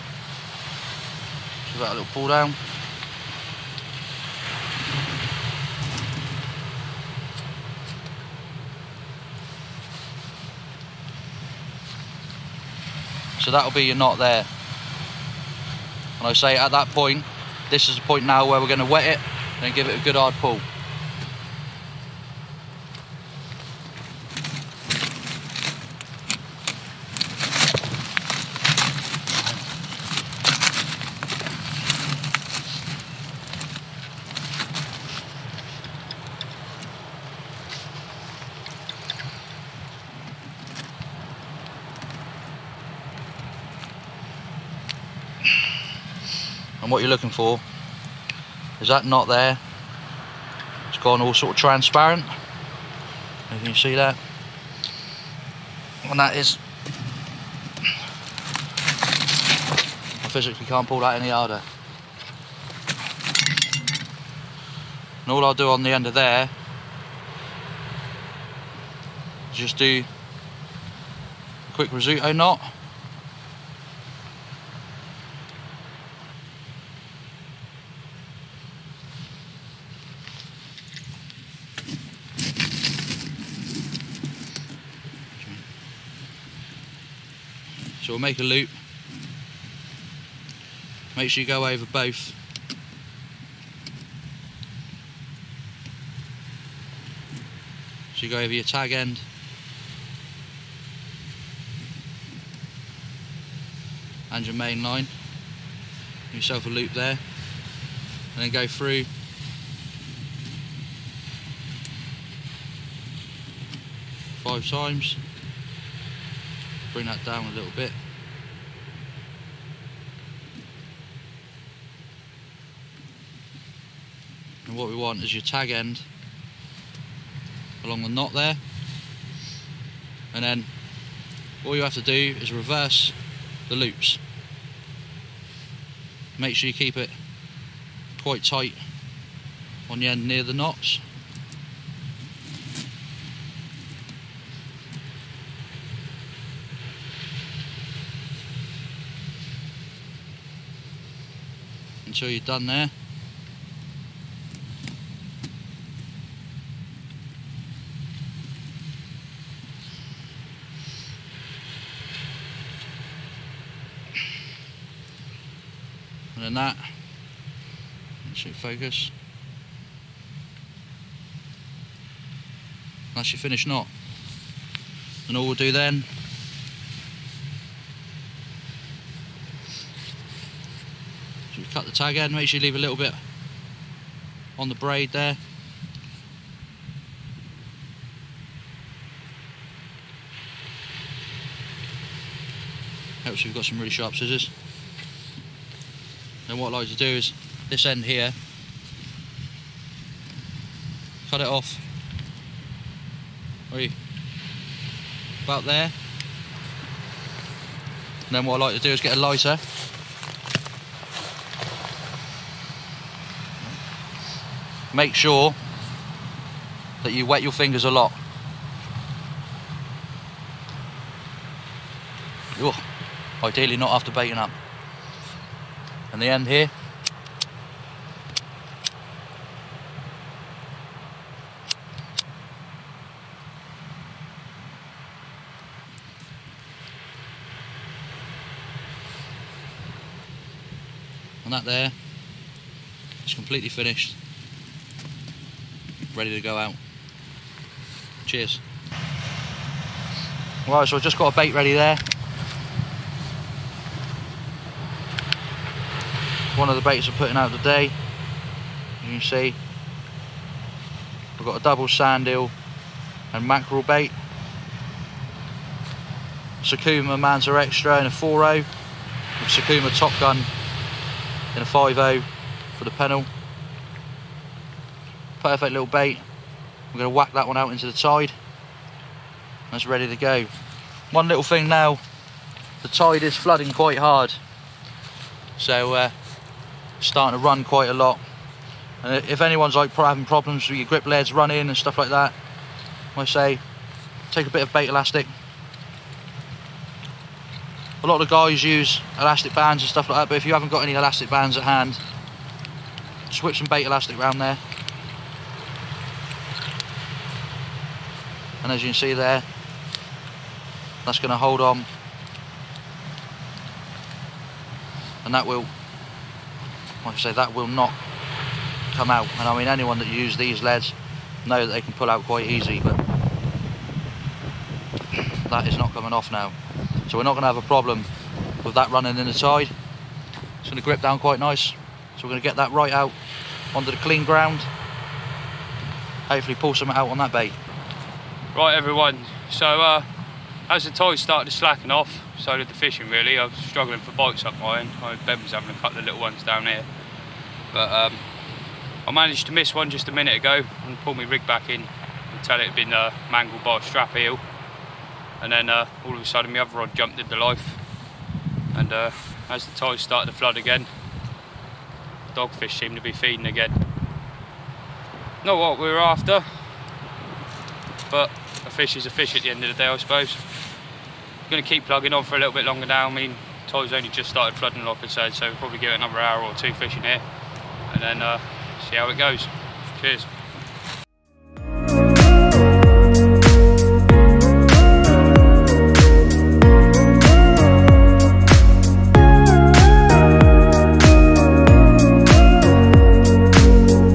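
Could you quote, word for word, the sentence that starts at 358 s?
And uh, as the tide started to flood again, dogfish seemed to be feeding again.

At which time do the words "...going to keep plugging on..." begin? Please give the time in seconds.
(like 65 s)
371 s.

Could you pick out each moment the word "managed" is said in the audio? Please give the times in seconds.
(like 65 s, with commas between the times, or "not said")
349 s.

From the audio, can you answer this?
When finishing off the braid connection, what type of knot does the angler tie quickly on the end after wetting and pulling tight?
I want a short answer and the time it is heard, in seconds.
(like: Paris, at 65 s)
Rizzuto knot, at 71 s.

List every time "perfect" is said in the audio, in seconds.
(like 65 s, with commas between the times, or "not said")
275 s.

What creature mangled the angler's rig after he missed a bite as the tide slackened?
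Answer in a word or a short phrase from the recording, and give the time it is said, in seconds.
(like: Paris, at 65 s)
strap eel, at 353 s.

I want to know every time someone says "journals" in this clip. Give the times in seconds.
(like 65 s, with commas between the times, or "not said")
not said.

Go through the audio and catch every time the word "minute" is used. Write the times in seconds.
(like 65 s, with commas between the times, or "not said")
350 s.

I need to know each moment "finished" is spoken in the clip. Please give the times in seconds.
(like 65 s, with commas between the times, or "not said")
173 s, 243 s.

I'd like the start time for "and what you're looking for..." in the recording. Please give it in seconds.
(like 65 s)
46 s.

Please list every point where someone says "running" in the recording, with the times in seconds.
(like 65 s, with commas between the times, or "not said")
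291 s, 328 s.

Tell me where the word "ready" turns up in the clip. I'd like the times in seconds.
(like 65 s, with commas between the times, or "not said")
246 s, 251 s, 279 s.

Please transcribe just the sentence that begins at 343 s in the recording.
I was struggling for bites up my end.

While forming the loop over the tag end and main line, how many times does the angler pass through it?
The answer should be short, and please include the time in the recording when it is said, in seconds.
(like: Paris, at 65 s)
5, at 114 s.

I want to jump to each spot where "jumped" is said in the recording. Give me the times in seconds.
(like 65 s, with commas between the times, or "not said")
356 s.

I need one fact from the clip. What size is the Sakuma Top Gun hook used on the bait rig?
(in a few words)
5-0.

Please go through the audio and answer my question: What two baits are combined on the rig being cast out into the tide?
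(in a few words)
sand eel and mackerel.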